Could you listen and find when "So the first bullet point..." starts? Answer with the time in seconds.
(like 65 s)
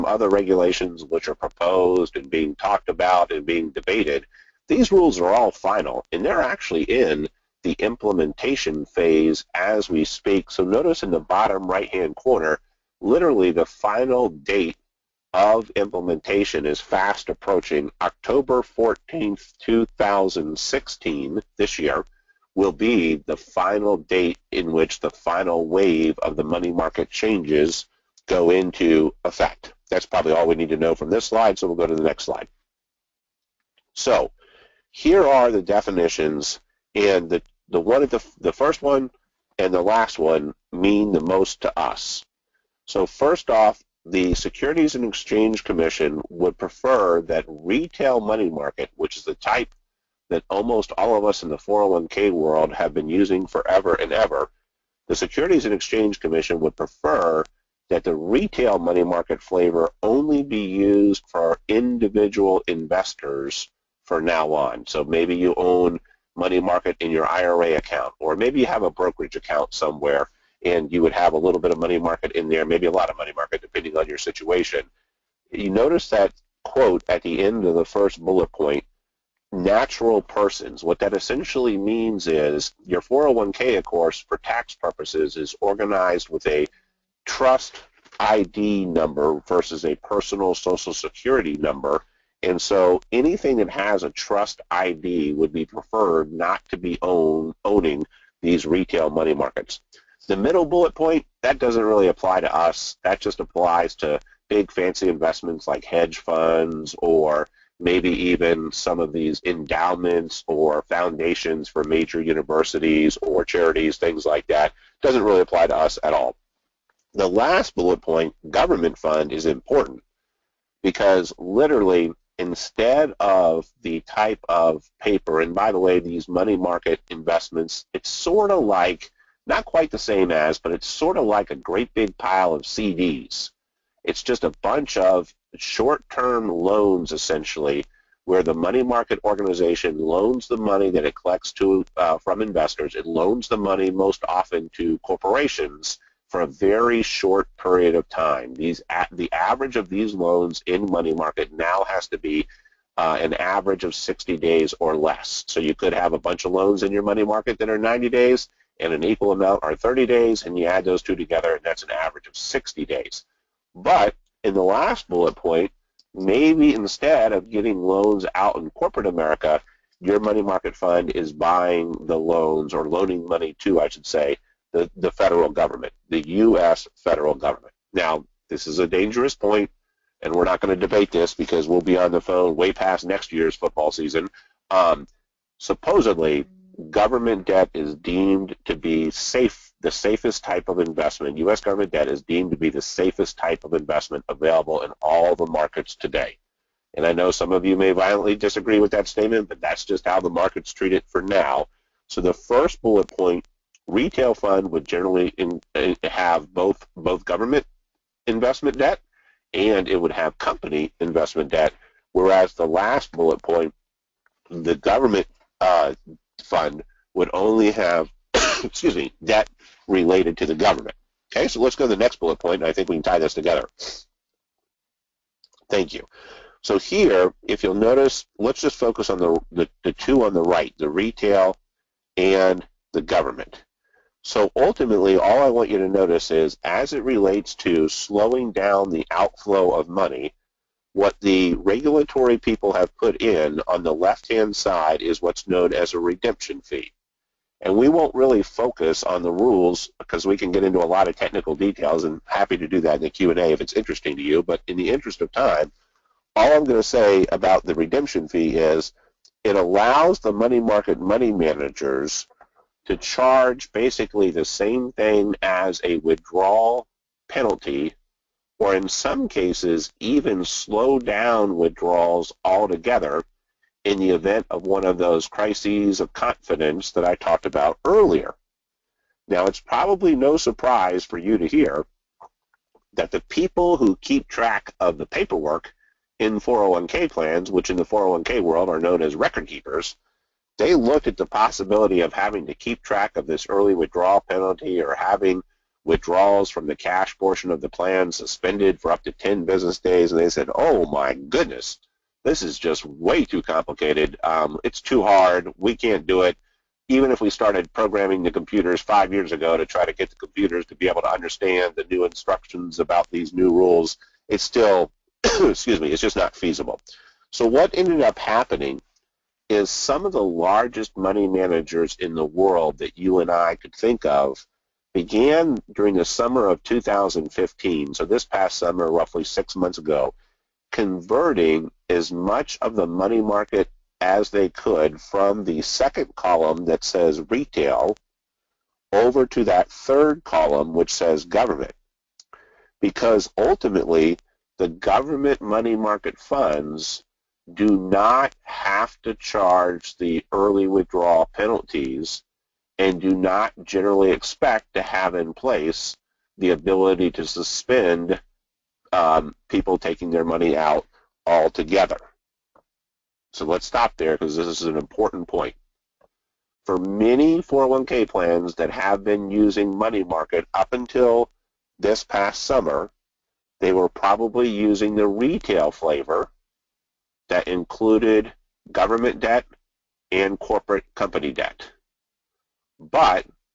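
202 s.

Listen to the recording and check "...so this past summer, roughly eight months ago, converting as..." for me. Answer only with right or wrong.
wrong.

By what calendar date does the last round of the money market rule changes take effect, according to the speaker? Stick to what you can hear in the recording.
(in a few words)
October 14th, 2016.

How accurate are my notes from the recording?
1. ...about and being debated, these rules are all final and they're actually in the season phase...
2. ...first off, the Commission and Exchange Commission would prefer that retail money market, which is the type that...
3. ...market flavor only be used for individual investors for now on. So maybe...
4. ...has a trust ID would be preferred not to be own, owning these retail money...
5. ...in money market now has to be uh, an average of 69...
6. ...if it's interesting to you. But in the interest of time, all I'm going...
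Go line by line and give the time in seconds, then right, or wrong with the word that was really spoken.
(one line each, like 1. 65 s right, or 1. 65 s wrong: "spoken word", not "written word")
1. 2 s wrong: "implementation", not "season"
2. 43 s wrong: "Securities", not "Commission"
3. 59 s right
4. 93 s right
5. 150 s wrong: "60", not "69"
6. 253 s right.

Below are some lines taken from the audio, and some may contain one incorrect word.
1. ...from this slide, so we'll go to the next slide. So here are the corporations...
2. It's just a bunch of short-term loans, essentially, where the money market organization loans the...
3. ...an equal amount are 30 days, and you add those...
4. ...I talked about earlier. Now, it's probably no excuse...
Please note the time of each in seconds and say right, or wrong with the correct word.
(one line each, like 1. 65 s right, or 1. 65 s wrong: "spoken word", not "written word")
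1. 30 s wrong: "definitions", not "corporations"
2. 134 s right
3. 158 s right
4. 277 s wrong: "surprise", not "excuse".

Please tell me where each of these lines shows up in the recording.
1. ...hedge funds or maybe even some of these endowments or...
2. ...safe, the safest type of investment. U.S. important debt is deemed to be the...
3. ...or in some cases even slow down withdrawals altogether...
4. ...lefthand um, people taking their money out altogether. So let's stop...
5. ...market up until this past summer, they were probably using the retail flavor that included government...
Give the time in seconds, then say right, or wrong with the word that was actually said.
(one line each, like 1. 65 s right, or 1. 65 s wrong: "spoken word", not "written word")
1. 105 s right
2. 189 s wrong: "government", not "important"
3. 268 s right
4. 357 s wrong: "suspend", not "lefthand"
5. 370 s right.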